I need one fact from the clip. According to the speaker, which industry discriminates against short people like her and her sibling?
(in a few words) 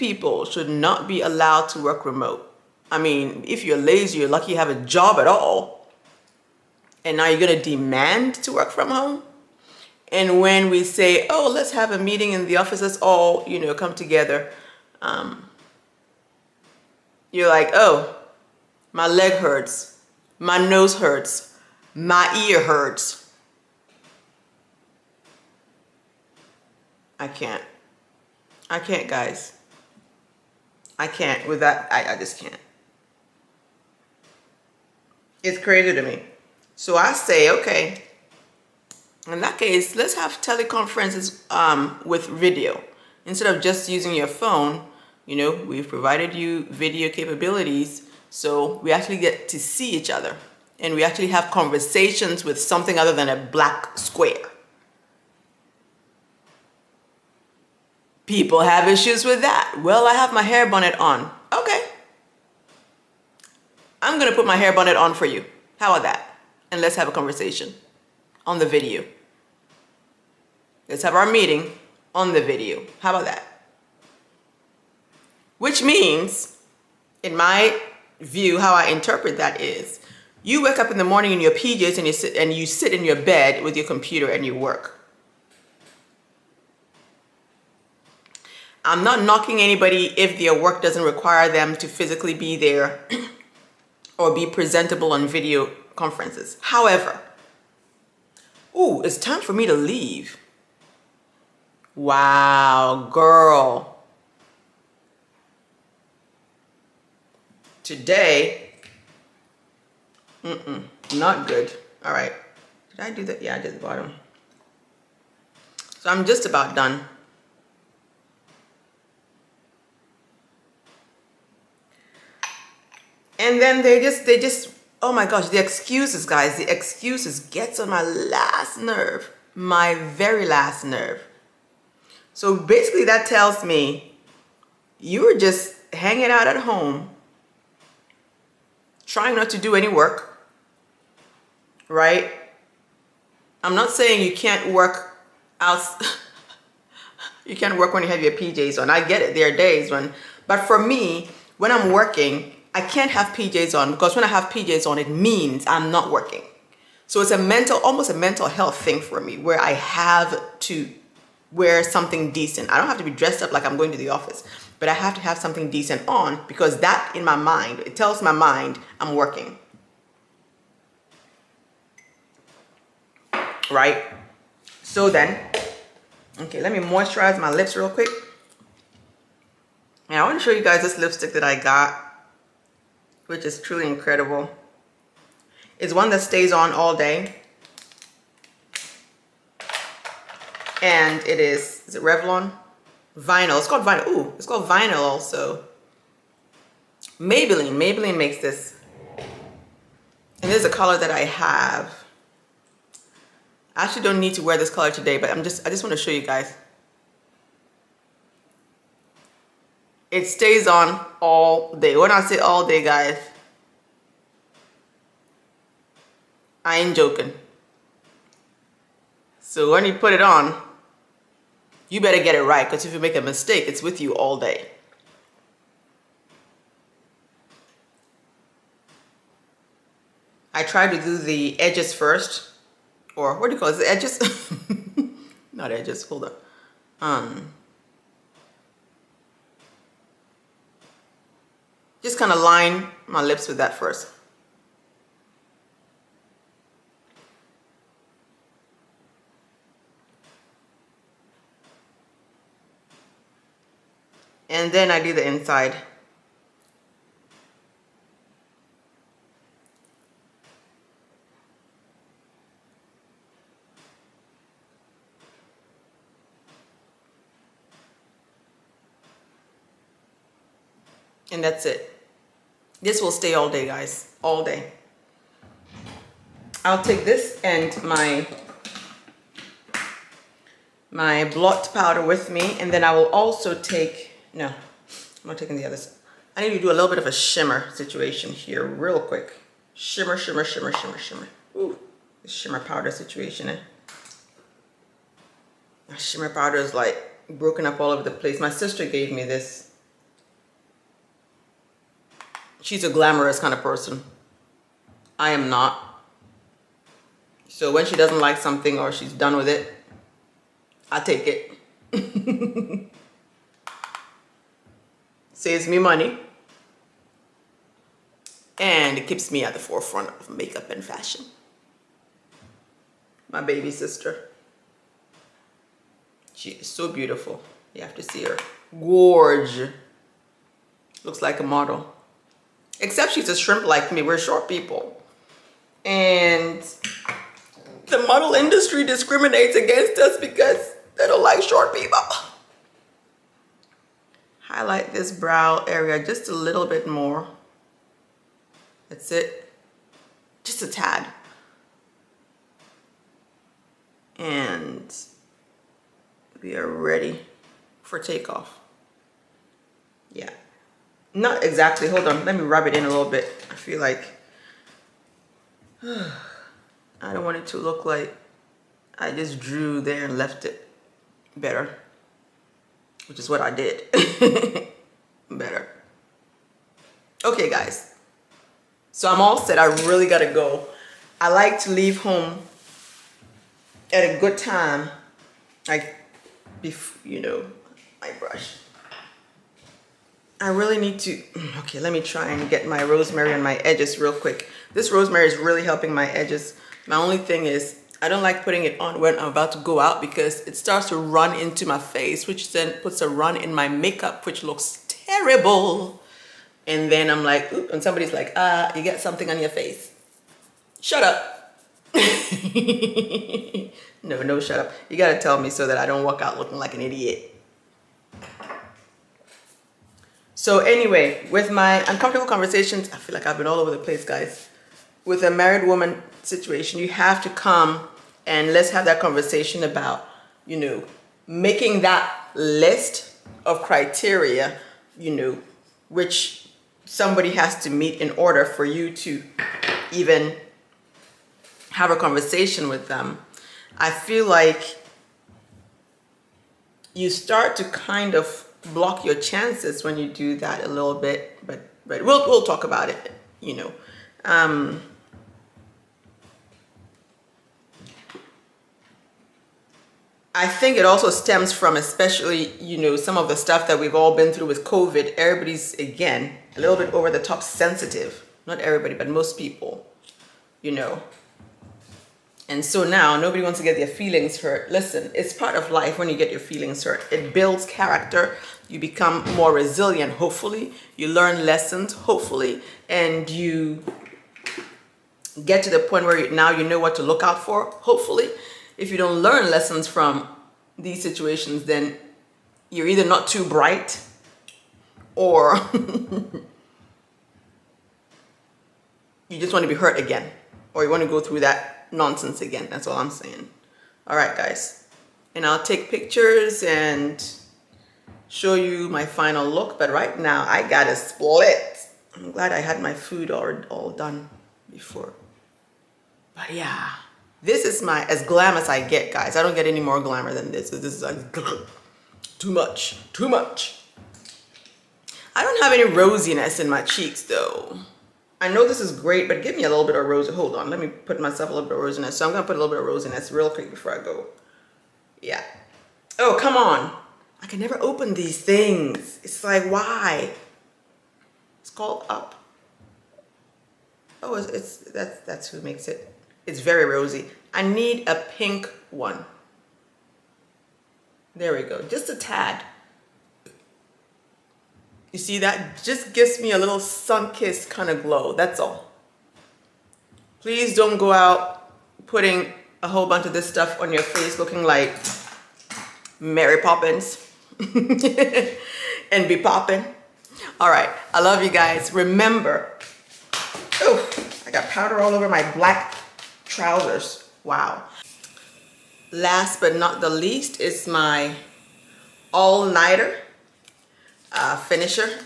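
The model industry.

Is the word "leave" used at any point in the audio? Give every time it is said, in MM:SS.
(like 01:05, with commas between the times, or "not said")
01:39, 06:21.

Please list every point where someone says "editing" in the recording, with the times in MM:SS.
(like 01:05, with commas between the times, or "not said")
not said.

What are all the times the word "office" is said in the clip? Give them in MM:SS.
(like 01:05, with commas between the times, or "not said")
00:12, 02:44.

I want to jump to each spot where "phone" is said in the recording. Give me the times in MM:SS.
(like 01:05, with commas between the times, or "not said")
00:44.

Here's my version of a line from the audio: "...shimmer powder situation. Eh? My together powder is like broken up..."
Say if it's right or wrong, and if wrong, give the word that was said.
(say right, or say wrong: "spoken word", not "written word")
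wrong: "shimmer", not "together".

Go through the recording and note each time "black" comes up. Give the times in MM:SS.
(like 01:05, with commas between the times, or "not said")
00:53, 09:35.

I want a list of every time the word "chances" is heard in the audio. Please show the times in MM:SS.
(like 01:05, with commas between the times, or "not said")
07:29.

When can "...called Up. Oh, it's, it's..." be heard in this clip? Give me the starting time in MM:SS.
09:01.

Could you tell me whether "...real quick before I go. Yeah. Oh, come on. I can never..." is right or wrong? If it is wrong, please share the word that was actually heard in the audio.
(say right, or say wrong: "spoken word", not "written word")
right.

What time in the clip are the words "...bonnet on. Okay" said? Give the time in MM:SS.
01:00.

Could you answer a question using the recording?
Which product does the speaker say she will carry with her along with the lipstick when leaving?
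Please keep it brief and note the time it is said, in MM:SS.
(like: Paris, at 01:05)
Blot powder, at 04:41.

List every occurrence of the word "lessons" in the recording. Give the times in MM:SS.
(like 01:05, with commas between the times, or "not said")
08:01, 08:09.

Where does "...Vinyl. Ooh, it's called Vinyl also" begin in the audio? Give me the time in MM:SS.
03:13.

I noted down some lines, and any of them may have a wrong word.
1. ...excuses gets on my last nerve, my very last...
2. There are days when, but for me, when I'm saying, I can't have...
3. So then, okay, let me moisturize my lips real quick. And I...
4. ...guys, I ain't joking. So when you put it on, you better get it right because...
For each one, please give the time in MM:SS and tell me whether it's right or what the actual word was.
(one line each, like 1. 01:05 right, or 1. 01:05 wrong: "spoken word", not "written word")
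1. 02:06 right
2. 02:29 wrong: "working", not "saying"
3. 02:54 right
4. 03:32 right.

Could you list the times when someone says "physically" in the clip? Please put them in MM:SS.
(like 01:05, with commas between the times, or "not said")
01:31.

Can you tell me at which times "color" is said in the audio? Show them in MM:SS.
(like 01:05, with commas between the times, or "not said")
03:20, 03:24.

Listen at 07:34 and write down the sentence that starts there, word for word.
Um, I think it also stems from especially, you know, some of the stuff that we've all been through with COVID.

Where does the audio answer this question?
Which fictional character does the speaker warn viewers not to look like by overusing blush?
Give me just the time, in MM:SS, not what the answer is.
09:26.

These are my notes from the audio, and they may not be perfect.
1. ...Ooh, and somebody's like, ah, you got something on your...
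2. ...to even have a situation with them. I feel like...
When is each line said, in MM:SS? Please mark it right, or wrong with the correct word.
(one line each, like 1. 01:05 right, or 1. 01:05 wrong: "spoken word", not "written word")
1. 06:47 right
2. 07:18 wrong: "conversation", not "situation".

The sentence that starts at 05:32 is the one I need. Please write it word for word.
Except she's a shrimp like me.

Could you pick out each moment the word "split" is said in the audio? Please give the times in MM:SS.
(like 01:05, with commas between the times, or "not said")
08:30.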